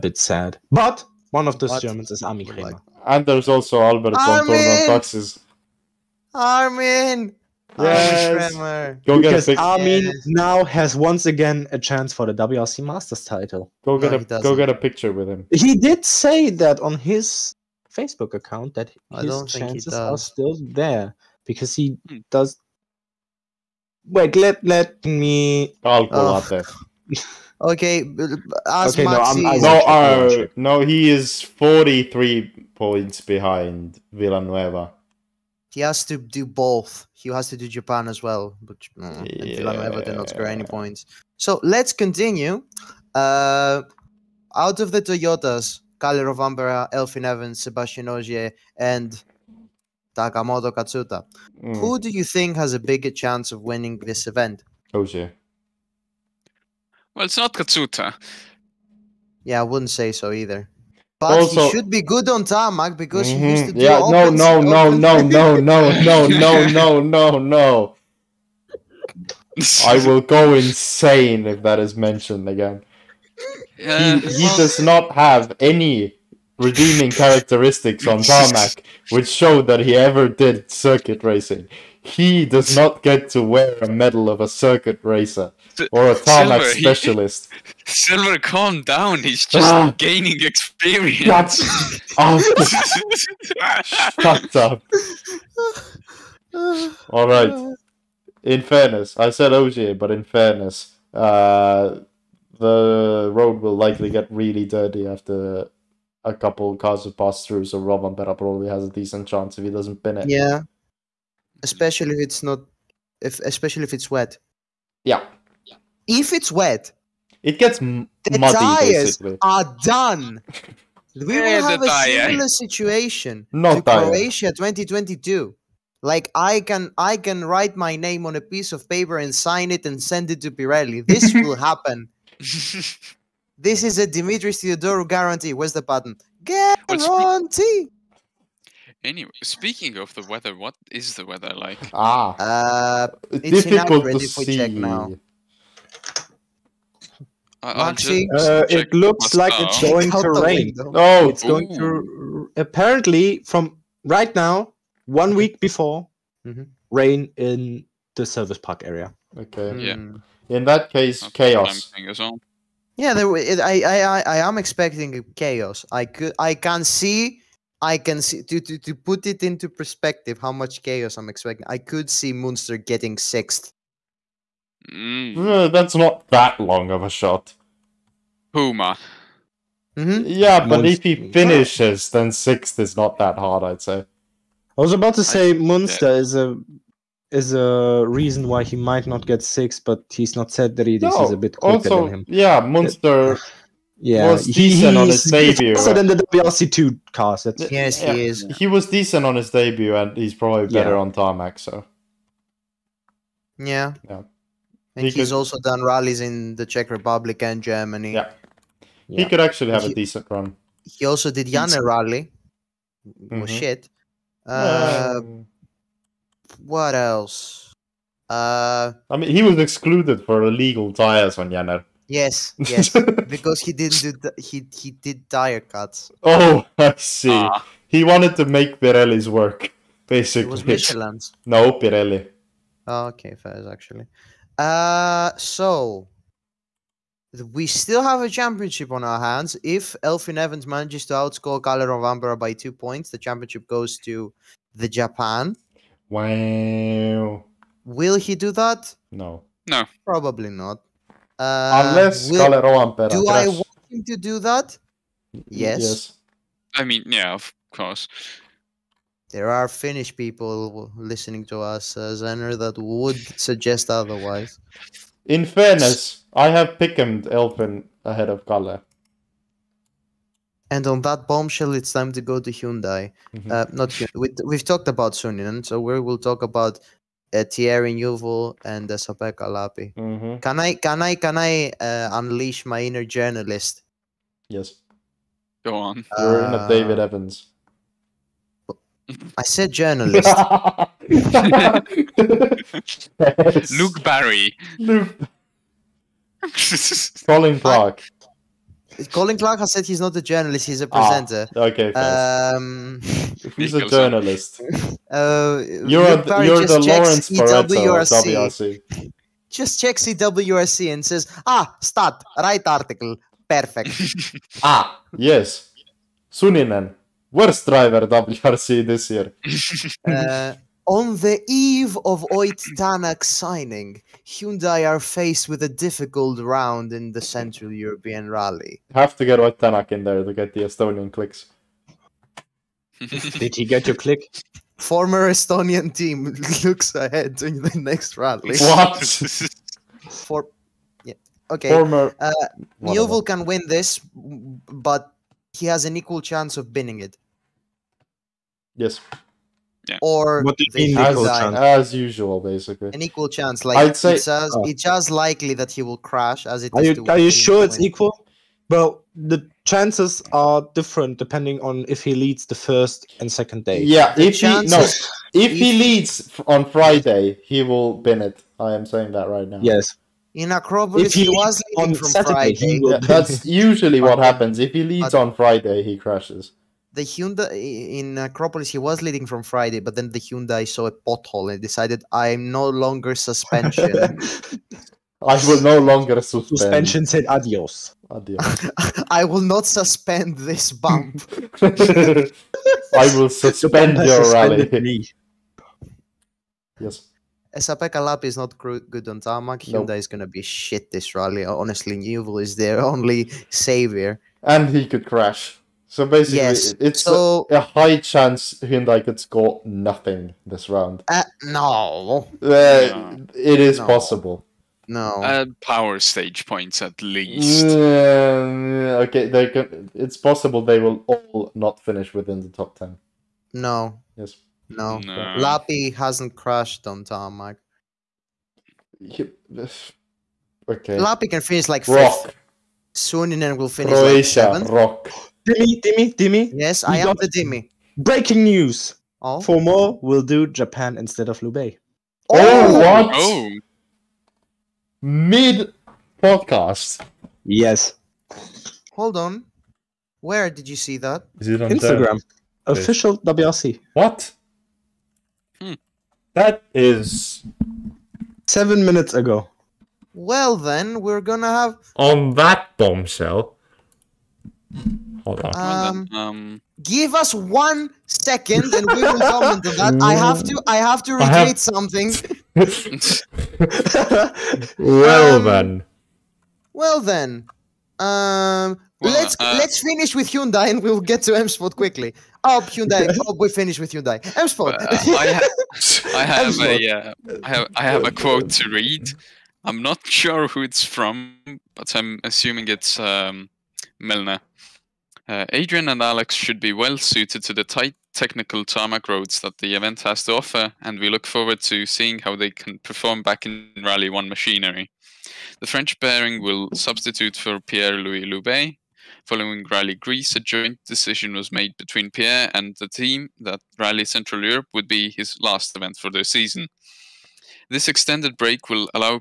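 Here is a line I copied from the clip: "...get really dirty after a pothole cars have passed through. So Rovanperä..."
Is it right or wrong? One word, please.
wrong.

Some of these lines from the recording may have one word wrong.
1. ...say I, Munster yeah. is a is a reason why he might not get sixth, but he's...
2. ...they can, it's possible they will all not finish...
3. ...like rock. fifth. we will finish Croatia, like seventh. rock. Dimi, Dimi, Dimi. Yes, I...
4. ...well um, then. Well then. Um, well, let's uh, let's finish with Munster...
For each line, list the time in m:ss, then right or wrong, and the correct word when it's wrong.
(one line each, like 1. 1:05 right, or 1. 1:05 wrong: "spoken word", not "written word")
1. 3:05 right
2. 6:59 right
3. 7:11 right
4. 7:54 wrong: "Hyundai", not "Munster".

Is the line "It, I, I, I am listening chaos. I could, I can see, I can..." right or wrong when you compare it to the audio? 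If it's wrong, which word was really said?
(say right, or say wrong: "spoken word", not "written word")
wrong: "expecting", not "listening".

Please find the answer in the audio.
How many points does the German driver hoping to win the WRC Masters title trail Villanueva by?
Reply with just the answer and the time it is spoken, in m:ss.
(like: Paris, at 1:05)
43, at 0:31.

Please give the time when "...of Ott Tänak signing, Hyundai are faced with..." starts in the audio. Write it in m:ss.
5:22.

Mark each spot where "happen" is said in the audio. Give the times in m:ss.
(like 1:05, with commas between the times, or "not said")
2:11, 6:14.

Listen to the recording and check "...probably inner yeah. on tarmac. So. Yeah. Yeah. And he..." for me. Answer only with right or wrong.
wrong.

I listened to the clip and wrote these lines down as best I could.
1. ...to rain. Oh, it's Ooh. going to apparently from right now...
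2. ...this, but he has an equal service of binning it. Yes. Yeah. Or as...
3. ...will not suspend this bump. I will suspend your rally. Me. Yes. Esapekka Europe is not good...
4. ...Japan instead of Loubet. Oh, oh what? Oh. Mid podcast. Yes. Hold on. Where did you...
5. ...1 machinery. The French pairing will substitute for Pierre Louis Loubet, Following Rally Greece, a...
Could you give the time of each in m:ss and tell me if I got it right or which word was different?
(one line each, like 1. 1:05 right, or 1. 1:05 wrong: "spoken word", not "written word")
1. 2:30 right
2. 5:43 wrong: "chance", not "service"
3. 6:29 wrong: "Lappi", not "Europe"
4. 7:20 right
5. 8:24 right.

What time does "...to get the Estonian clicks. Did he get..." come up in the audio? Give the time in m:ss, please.
5:30.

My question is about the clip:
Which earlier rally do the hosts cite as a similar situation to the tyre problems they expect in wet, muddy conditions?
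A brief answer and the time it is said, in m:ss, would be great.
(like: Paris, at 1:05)
Croatia 2022, at 2:04.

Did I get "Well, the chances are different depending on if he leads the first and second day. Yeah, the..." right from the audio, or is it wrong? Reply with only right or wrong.
right.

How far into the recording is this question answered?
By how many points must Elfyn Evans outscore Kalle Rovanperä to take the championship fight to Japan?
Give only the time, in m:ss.
4:02.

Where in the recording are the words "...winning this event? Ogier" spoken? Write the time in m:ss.
0:53.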